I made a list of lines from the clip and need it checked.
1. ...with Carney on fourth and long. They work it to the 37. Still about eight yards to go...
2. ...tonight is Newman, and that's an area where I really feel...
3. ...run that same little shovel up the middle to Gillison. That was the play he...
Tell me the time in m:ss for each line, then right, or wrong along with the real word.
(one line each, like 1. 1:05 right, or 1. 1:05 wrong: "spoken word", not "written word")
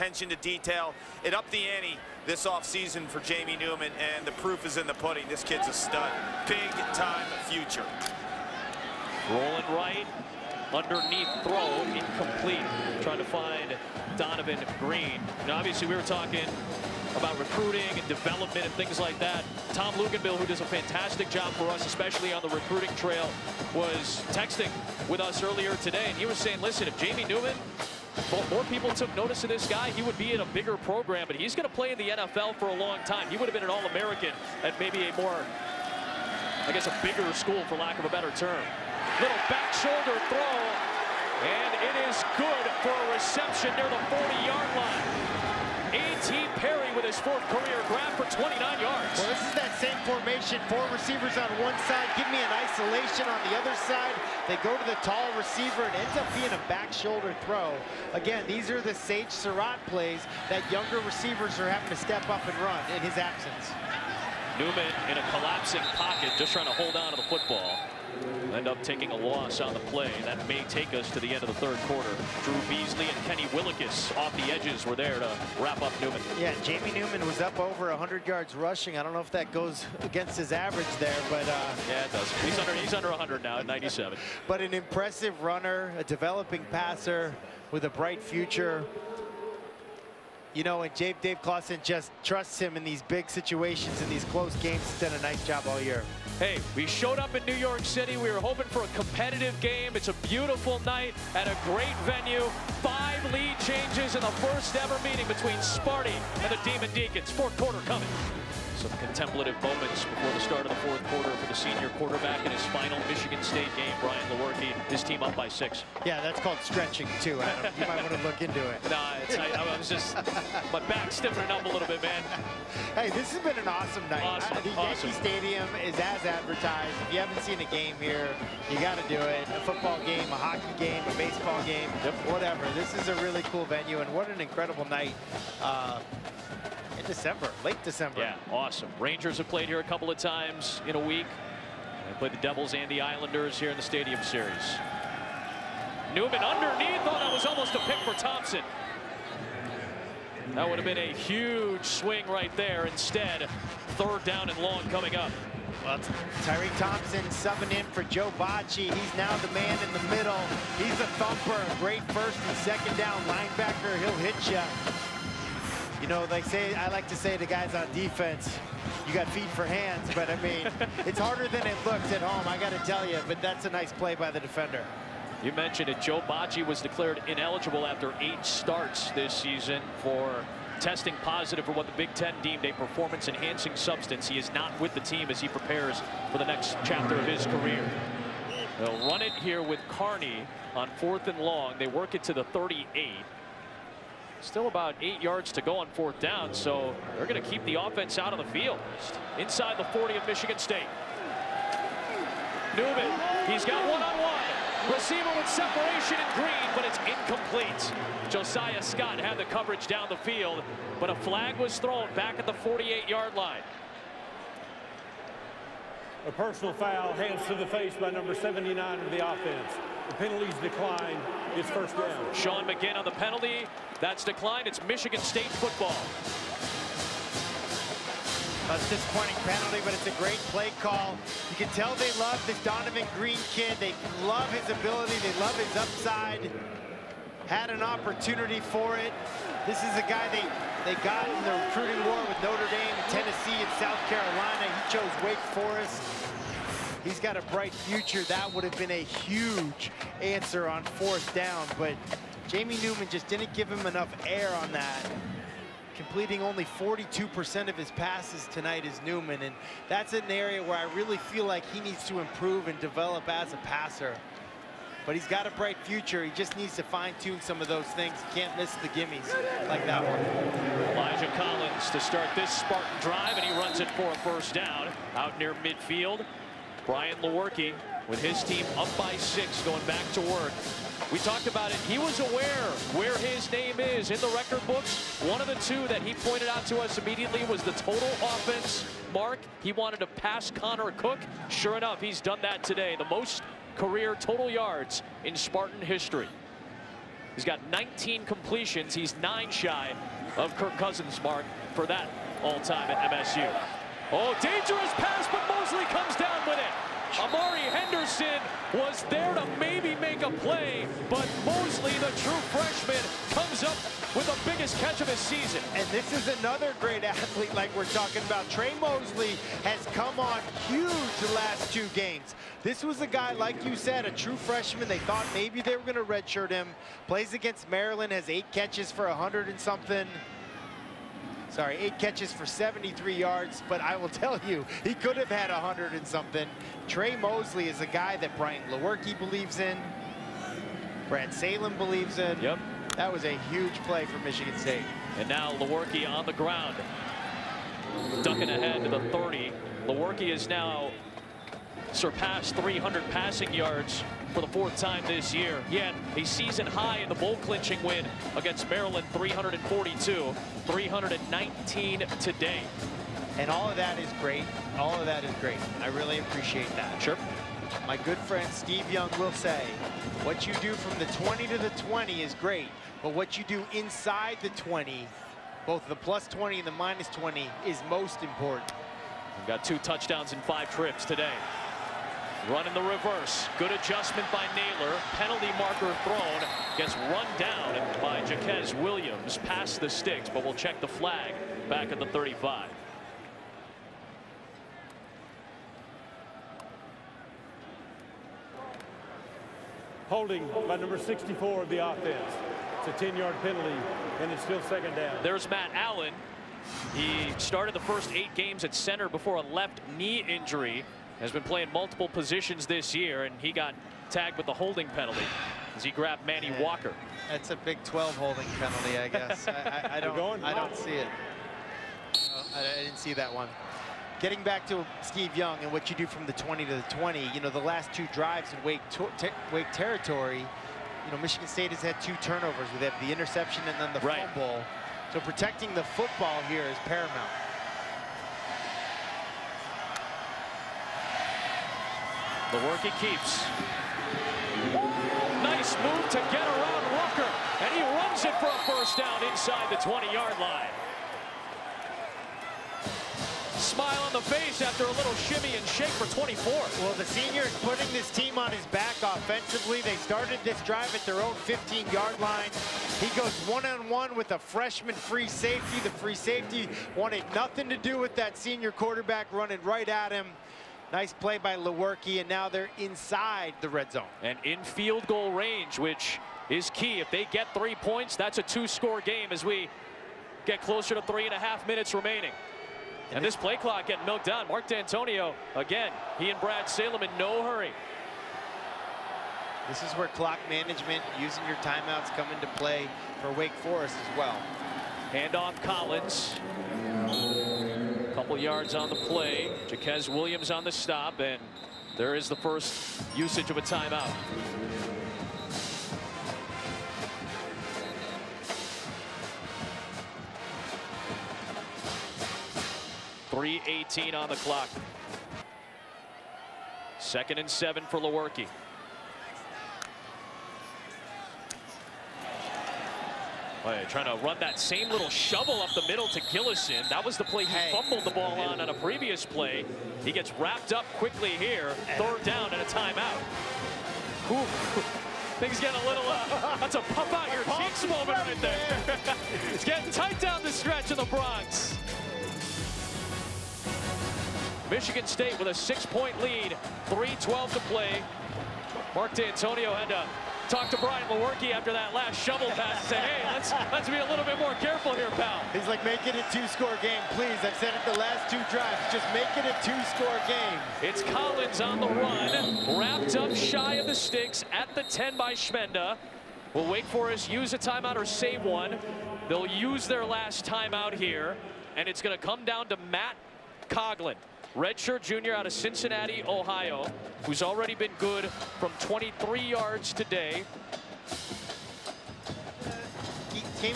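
1. 3:09 wrong: "38", not "37"
2. 4:18 right
3. 8:44 right.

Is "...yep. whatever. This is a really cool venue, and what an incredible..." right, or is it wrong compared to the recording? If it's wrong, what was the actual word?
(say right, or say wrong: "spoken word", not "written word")
right.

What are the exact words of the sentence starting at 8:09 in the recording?
This is where clock management, using your timeouts, come into play for Wake Forest as well.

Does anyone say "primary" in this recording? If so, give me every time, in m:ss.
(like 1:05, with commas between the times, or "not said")
not said.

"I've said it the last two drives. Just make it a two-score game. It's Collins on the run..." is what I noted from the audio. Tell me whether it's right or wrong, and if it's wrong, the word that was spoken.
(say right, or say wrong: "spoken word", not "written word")
right.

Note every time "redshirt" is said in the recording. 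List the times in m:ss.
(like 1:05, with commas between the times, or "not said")
5:26, 9:34.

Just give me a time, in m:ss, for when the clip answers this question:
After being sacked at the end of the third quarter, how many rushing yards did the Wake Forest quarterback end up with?
1:23.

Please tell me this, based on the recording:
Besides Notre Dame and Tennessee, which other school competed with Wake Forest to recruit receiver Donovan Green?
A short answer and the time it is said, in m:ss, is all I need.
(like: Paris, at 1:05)
South Carolina, at 4:03.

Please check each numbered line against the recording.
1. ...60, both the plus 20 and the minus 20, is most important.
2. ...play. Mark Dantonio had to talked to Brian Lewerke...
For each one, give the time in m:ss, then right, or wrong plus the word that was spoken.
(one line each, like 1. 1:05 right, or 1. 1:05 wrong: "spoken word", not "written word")
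1. 6:14 wrong: "20", not "60"
2. 9:07 right.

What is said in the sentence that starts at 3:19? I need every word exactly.
Inside the 40 of Michigan State.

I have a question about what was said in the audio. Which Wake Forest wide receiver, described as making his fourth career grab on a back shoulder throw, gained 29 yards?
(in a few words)
A.T. Perry.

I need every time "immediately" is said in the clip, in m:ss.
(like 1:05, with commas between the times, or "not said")
4:46.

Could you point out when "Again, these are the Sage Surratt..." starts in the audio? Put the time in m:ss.
0:58.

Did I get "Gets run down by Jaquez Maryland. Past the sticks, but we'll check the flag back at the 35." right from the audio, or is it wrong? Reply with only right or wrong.
wrong.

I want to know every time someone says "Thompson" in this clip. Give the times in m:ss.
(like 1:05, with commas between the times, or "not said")
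2:28, 2:36.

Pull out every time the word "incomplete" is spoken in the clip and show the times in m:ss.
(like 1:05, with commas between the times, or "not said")
0:11, 3:27.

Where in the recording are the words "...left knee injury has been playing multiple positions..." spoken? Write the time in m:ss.
6:49.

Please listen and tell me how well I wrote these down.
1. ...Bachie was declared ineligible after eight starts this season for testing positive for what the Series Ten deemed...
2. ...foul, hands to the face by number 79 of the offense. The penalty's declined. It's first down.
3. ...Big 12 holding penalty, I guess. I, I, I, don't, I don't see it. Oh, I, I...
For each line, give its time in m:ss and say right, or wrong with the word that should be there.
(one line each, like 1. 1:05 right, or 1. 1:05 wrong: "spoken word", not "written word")
1. 2:56 wrong: "Big", not "Series"
2. 3:36 right
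3. 6:57 right.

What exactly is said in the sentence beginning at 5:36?
Tre Mosley is a guy that Brian Lewerke believes in, Brad Salem believes in.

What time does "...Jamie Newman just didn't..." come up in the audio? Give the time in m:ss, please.
4:12.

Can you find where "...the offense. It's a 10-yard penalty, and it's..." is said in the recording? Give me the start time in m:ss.
6:41.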